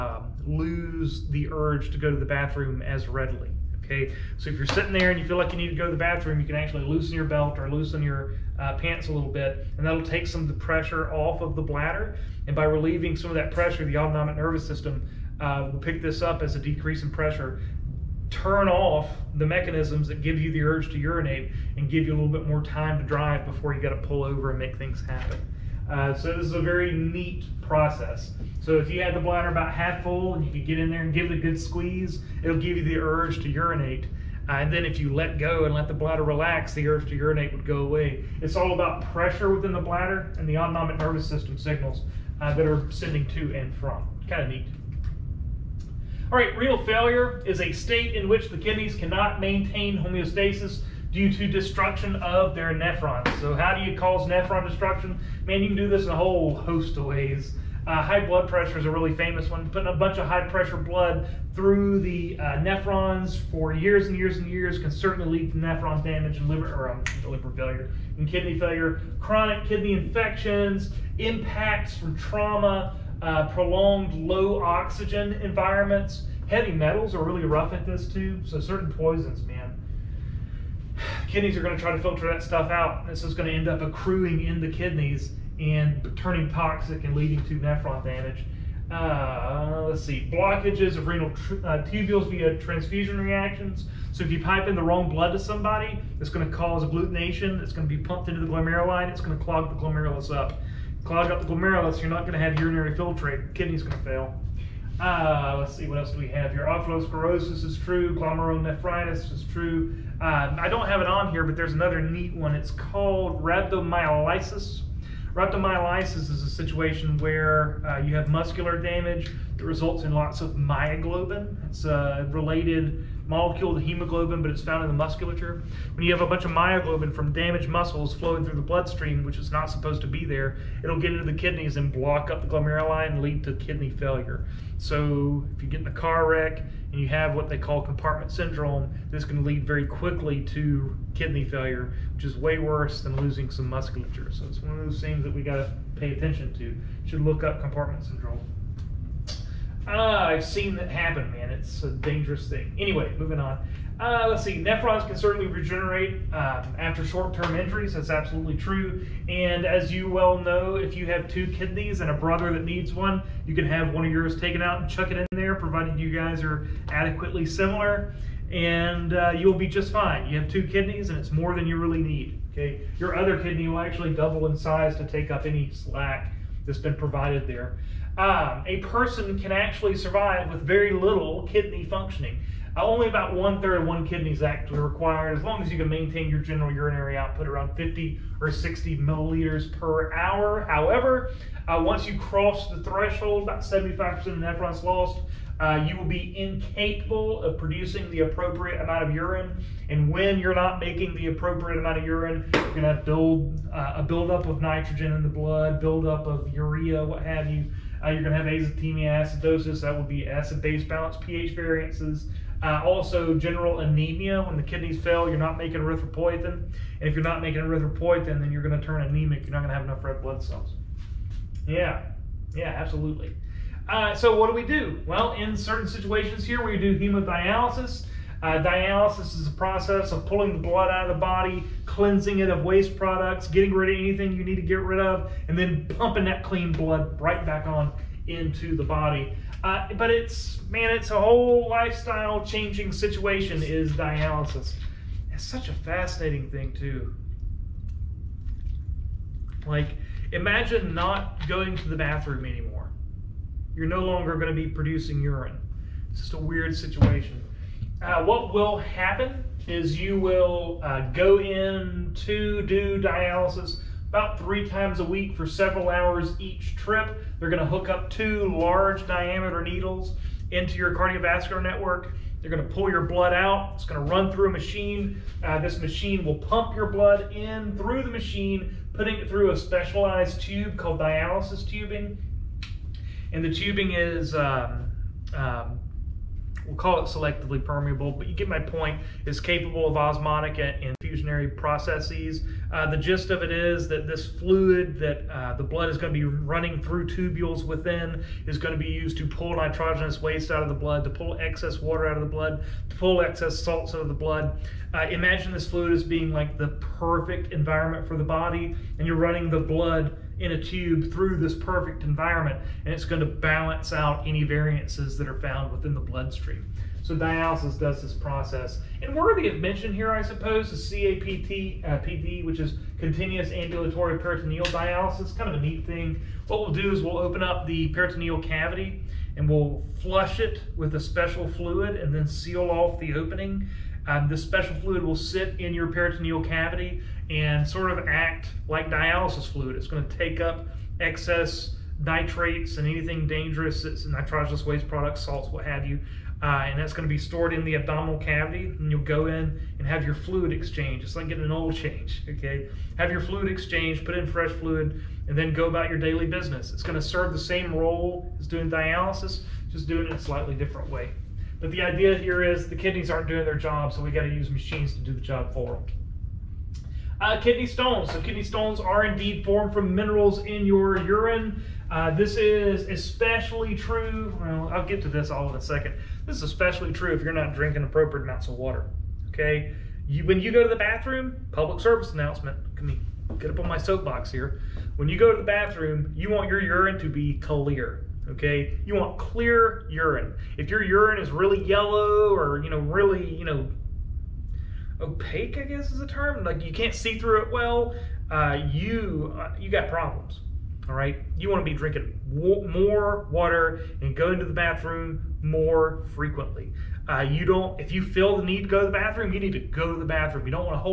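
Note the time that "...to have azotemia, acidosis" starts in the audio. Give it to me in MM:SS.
03:28.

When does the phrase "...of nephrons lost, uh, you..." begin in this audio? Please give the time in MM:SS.
03:14.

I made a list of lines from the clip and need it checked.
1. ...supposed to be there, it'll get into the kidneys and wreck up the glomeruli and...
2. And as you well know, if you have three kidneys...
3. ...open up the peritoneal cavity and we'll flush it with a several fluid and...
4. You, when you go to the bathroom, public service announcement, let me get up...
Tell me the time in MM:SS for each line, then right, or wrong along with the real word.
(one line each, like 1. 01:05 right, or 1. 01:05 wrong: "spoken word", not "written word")
1. 02:09 wrong: "block", not "wreck"
2. 02:39 wrong: "two", not "three"
3. 05:27 wrong: "special", not "several"
4. 06:20 right.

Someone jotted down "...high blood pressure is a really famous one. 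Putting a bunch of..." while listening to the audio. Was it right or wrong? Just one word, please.
right.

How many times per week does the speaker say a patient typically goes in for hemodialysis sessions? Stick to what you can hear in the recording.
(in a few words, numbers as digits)
3.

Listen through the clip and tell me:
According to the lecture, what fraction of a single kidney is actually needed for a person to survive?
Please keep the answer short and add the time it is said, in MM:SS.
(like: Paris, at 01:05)
One third, at 03:03.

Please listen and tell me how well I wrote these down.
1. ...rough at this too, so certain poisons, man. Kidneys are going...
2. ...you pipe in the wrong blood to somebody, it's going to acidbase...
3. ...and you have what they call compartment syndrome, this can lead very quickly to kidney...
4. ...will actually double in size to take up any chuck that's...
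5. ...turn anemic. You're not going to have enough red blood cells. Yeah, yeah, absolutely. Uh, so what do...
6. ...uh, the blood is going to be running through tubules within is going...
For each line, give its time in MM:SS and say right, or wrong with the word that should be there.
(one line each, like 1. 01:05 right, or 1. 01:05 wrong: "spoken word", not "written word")
1. 01:17 right
2. 01:34 wrong: "cause", not "acidbase"
3. 02:16 right
4. 02:53 wrong: "slack", not "chuck"
5. 03:38 right
6. 04:55 right.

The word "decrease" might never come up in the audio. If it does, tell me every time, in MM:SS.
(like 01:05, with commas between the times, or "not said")
00:16.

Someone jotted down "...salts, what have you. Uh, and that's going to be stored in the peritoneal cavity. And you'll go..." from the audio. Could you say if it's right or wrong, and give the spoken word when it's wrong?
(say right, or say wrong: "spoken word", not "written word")
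wrong: "abdominal", not "peritoneal".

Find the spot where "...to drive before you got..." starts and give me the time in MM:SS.
00:22.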